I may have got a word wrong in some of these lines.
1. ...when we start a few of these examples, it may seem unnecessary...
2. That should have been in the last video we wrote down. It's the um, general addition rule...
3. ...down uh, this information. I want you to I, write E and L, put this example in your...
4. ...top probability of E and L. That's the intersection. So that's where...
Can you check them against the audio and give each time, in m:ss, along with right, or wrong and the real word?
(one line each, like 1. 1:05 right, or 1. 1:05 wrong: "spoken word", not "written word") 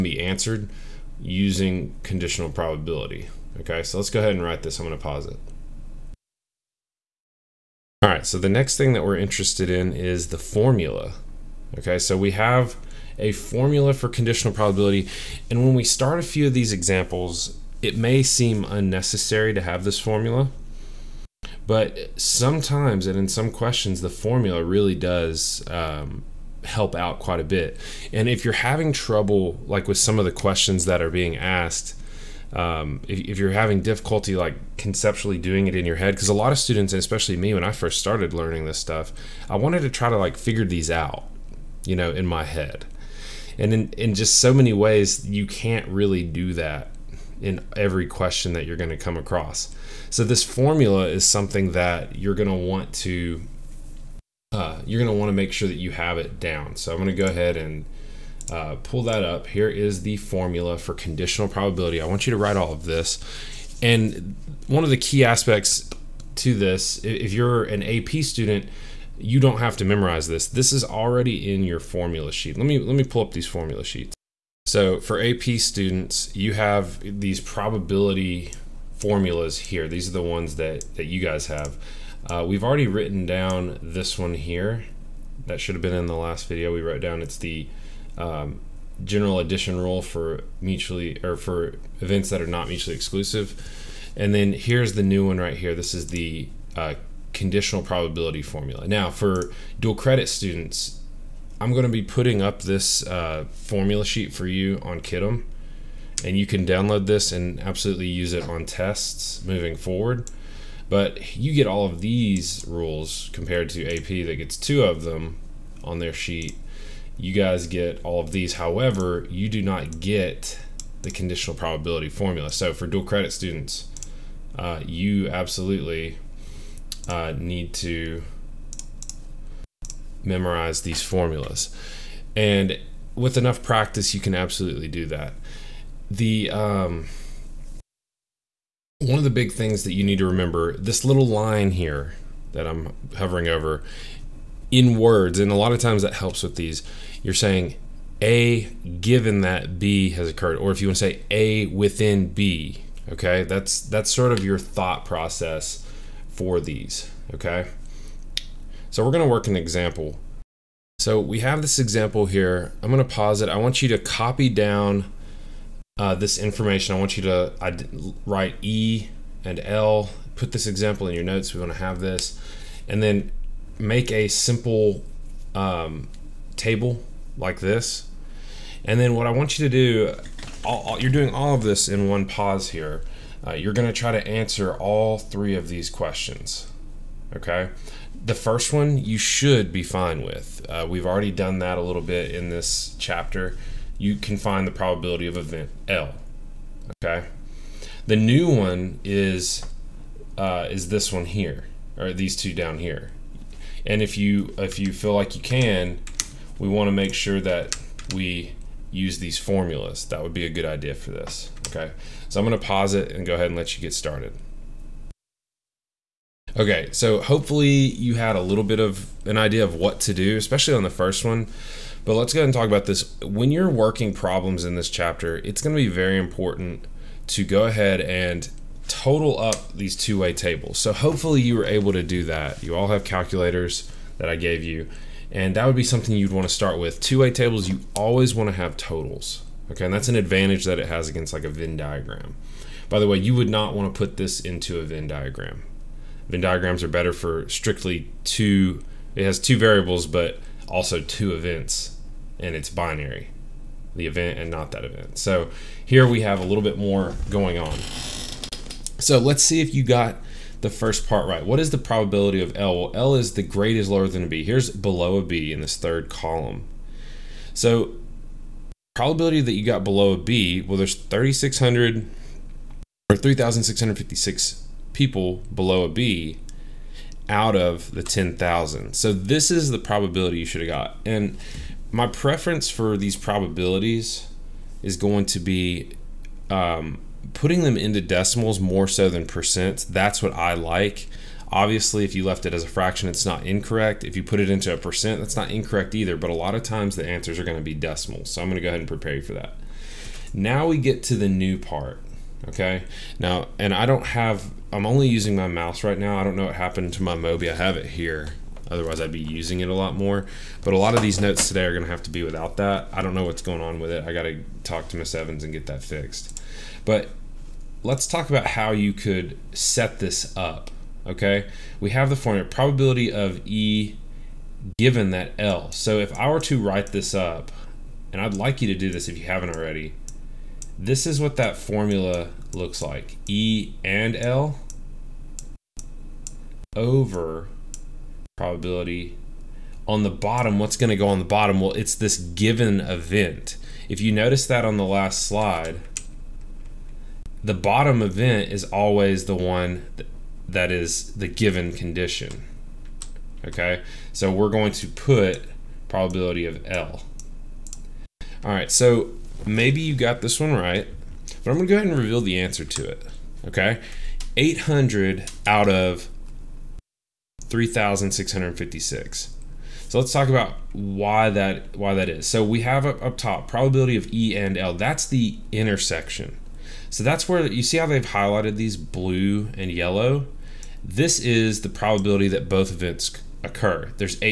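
1. 0:15 right
2. 1:25 right
3. 2:44 right
4. 6:13 right.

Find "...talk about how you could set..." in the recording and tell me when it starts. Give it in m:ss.
5:18.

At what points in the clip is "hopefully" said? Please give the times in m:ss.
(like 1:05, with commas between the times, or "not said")
3:37, 3:50.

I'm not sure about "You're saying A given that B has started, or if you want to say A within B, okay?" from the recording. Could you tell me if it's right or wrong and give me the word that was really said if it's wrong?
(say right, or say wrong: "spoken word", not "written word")
wrong: "occurred", not "started".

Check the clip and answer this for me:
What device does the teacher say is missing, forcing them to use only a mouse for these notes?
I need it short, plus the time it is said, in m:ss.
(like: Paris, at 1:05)
Mobi, at 5:07.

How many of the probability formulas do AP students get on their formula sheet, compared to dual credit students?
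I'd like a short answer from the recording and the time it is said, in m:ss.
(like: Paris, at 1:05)
2, at 1:54.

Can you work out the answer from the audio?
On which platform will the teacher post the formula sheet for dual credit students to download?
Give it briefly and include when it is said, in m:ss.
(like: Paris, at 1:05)
Kiddom, at 1:45.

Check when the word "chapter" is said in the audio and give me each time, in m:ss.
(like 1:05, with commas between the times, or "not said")
3:12, 3:44.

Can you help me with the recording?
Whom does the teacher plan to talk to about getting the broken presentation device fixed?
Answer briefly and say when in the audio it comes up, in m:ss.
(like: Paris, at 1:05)
Miss Evans, at 5:14.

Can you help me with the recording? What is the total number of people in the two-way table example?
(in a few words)
10,000.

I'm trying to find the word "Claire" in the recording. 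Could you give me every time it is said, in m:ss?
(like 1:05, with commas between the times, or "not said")
not said.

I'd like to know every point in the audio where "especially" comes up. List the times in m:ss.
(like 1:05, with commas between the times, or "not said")
0:36, 3:40.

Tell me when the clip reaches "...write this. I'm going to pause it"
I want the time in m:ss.
0:04.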